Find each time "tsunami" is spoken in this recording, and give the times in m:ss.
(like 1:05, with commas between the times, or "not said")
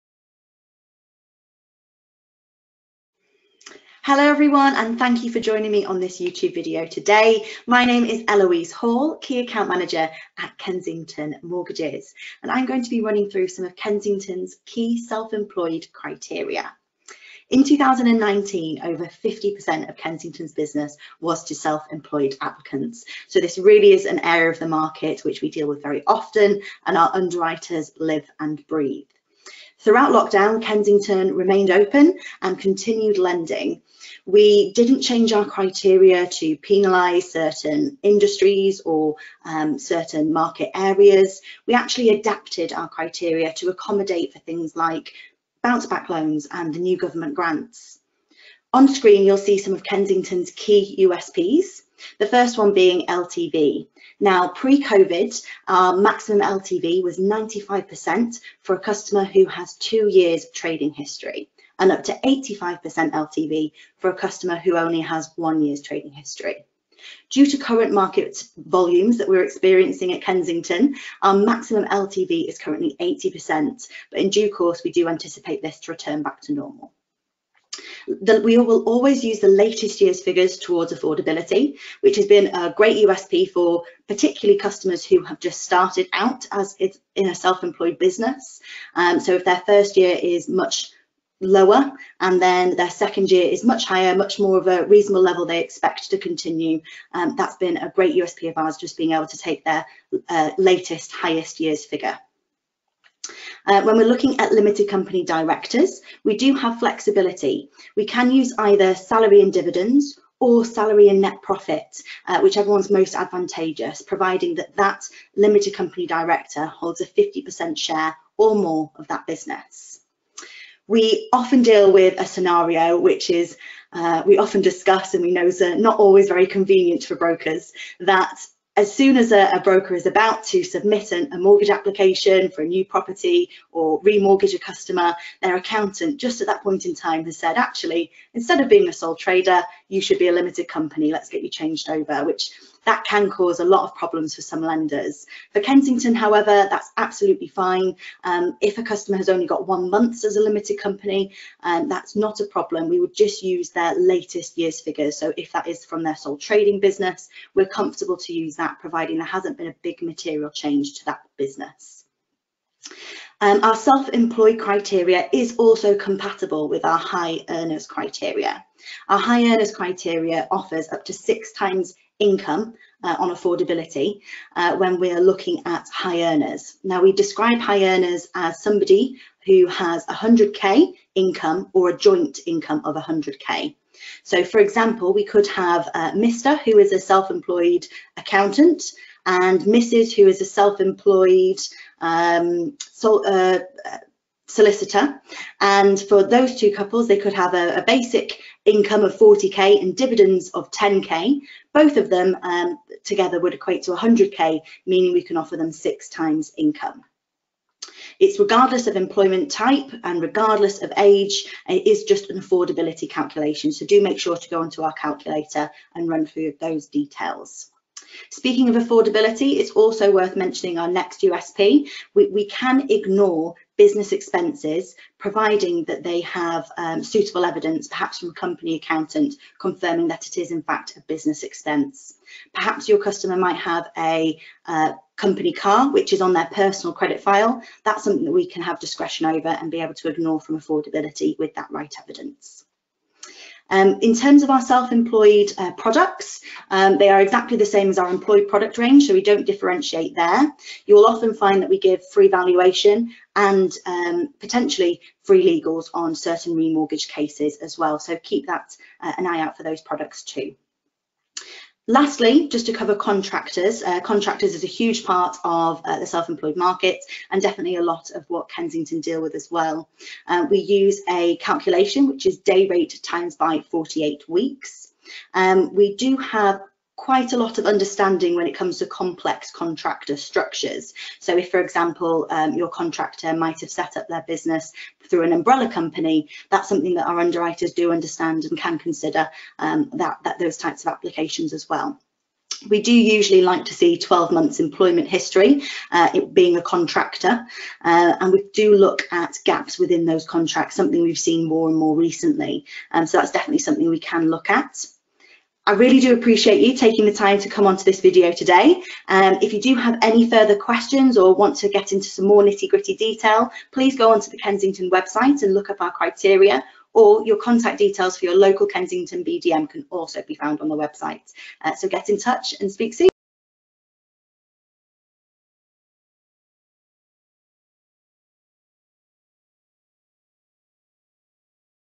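not said.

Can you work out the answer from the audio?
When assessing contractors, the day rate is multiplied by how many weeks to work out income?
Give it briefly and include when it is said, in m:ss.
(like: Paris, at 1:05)
48 weeks, at 4:33.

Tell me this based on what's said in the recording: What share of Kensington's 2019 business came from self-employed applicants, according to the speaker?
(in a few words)
over 50%.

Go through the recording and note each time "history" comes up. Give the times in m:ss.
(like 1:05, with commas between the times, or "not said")
1:00, 1:06, 4:55.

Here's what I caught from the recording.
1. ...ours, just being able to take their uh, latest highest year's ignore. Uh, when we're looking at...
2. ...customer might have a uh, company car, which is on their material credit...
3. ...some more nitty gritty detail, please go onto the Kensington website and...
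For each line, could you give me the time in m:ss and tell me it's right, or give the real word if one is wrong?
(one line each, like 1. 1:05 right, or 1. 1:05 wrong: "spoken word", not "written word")
1. 1:38 wrong: "figure", not "ignore"
2. 3:52 wrong: "personal", not "material"
3. 5:12 right.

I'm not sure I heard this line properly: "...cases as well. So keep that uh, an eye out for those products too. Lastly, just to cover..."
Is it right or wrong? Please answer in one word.
right.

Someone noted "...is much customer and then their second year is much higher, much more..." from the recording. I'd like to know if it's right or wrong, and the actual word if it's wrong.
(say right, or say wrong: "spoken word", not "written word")
wrong: "lower", not "customer".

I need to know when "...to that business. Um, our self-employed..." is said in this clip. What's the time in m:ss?
2:40.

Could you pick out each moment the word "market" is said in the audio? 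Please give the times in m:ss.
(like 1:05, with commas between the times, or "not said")
0:24, 0:40, 1:07, 4:26.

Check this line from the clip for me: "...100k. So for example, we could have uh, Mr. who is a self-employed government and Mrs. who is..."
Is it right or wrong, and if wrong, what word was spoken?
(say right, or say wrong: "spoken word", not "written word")
wrong: "accountant", not "government".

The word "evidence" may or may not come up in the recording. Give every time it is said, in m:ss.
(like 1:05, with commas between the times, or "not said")
3:47, 4:02.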